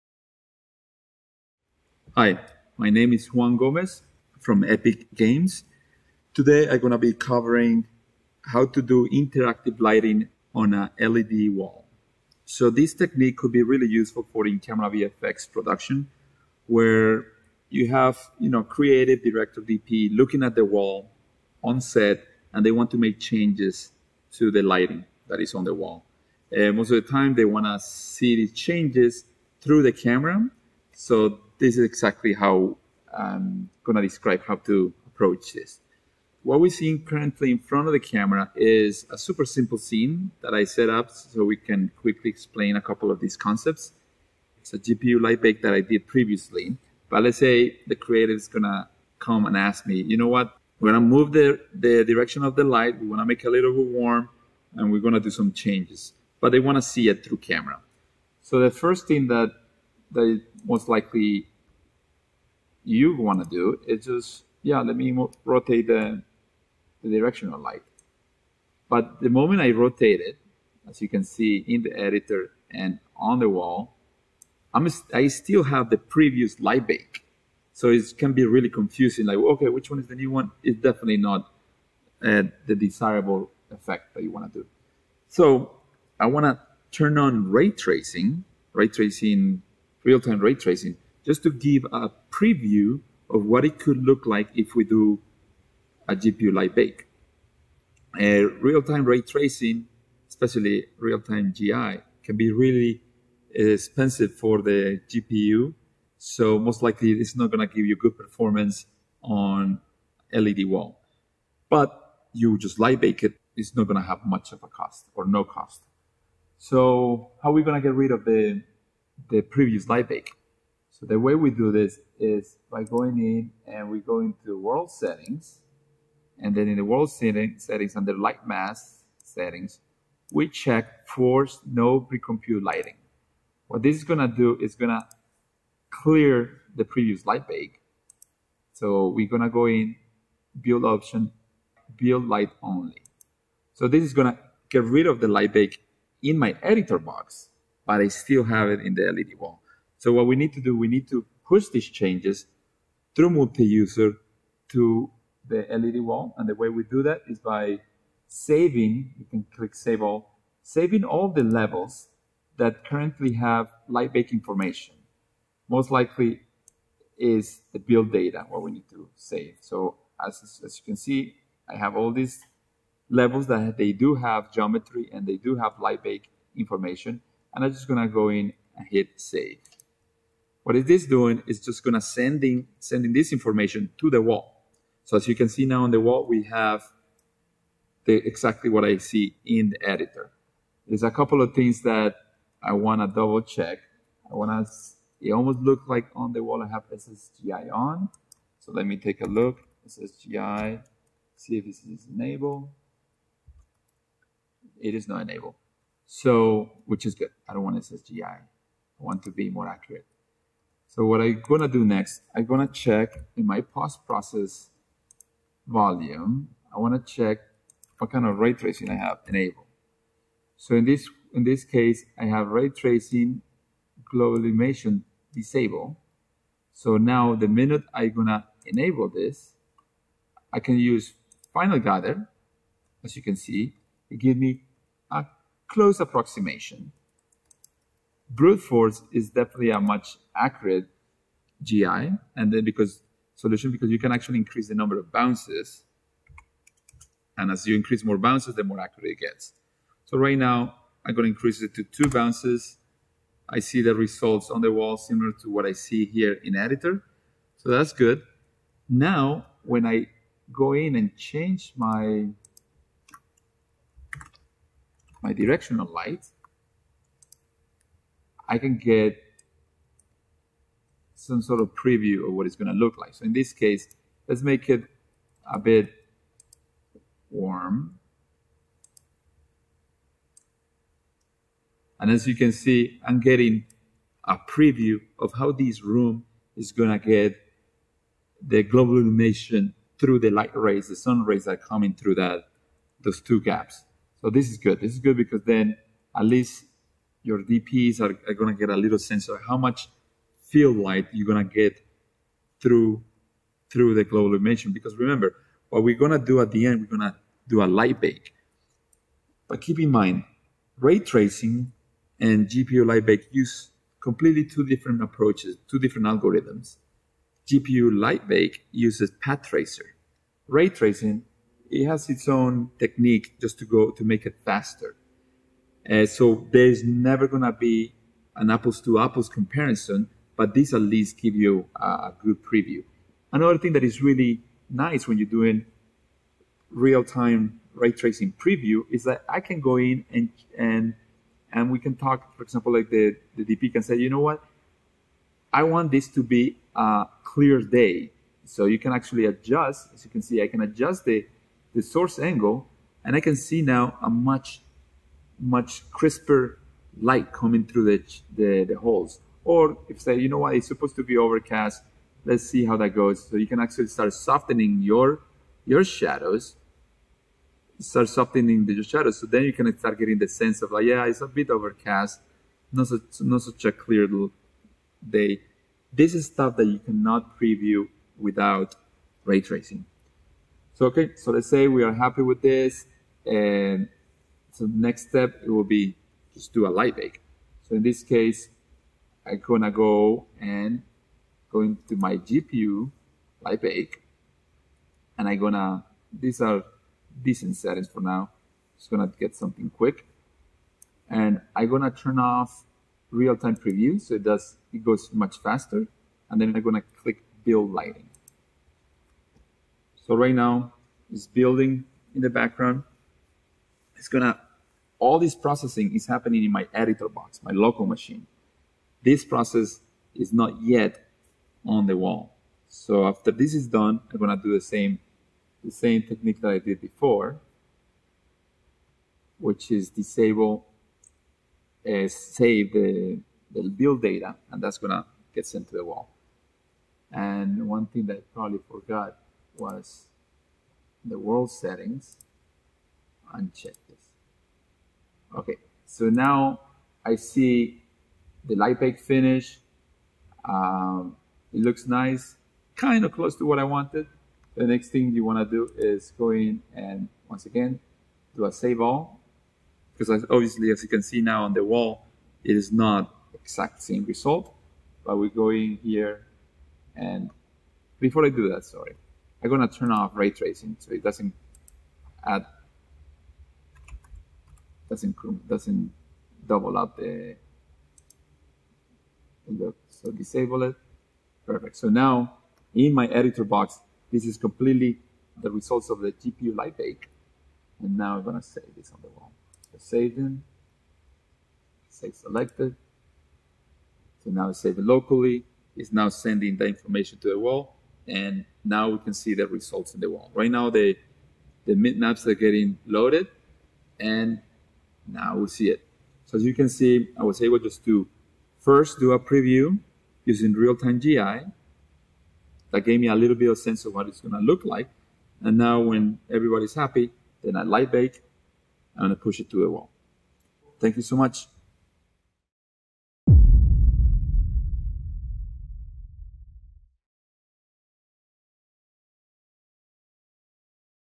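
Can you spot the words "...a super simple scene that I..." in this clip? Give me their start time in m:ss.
0:39.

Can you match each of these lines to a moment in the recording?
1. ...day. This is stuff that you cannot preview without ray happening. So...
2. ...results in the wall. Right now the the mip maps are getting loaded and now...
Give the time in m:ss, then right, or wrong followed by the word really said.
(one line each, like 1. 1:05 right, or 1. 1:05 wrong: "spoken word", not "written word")
1. 6:15 wrong: "tracing", not "happening"
2. 8:19 right.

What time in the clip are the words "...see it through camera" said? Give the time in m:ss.
0:56.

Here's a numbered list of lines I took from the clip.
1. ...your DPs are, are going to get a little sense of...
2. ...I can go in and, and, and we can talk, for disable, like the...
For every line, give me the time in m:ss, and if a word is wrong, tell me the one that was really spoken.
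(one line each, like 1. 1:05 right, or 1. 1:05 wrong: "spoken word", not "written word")
1. 4:57 right
2. 5:39 wrong: "example", not "disable".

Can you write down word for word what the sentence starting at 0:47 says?
But let's say the creative is going to come and ask me, you know what?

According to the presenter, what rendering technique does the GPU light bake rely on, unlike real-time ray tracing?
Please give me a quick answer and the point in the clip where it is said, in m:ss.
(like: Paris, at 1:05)
Path tracer, at 5:19.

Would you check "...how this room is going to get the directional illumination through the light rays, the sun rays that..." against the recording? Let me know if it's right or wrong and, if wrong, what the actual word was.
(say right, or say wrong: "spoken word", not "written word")
wrong: "global", not "directional".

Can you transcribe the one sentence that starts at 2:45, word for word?
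Most likely is the build data, what we need to save.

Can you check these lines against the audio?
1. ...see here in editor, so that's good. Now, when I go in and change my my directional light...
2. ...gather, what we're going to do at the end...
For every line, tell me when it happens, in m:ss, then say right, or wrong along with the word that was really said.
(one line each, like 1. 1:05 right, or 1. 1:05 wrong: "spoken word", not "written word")
1. 4:15 right
2. 5:04 wrong: "remember", not "gather".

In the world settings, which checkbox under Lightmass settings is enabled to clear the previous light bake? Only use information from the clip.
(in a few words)
Force no pre-compute lighting.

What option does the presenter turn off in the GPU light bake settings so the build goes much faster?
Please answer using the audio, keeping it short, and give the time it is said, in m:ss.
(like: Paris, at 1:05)
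Real-time preview, at 6:43.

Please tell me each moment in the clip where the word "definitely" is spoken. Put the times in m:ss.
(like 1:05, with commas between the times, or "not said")
1:20, 3:59.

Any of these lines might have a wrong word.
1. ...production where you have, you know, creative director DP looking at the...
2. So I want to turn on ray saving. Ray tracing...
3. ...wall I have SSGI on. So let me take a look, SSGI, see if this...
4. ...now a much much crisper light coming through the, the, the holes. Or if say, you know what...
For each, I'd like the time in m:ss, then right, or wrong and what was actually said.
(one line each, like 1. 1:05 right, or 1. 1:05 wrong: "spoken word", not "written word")
1. 0:15 right
2. 1:25 wrong: "tracing", not "saving"
3. 3:16 right
4. 5:53 right.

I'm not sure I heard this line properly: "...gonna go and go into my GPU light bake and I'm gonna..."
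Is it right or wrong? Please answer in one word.
right.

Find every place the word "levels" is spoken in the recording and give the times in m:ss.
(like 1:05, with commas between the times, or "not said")
2:41, 2:53.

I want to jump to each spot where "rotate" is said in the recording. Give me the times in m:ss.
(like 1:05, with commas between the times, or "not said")
1:05, 1:09.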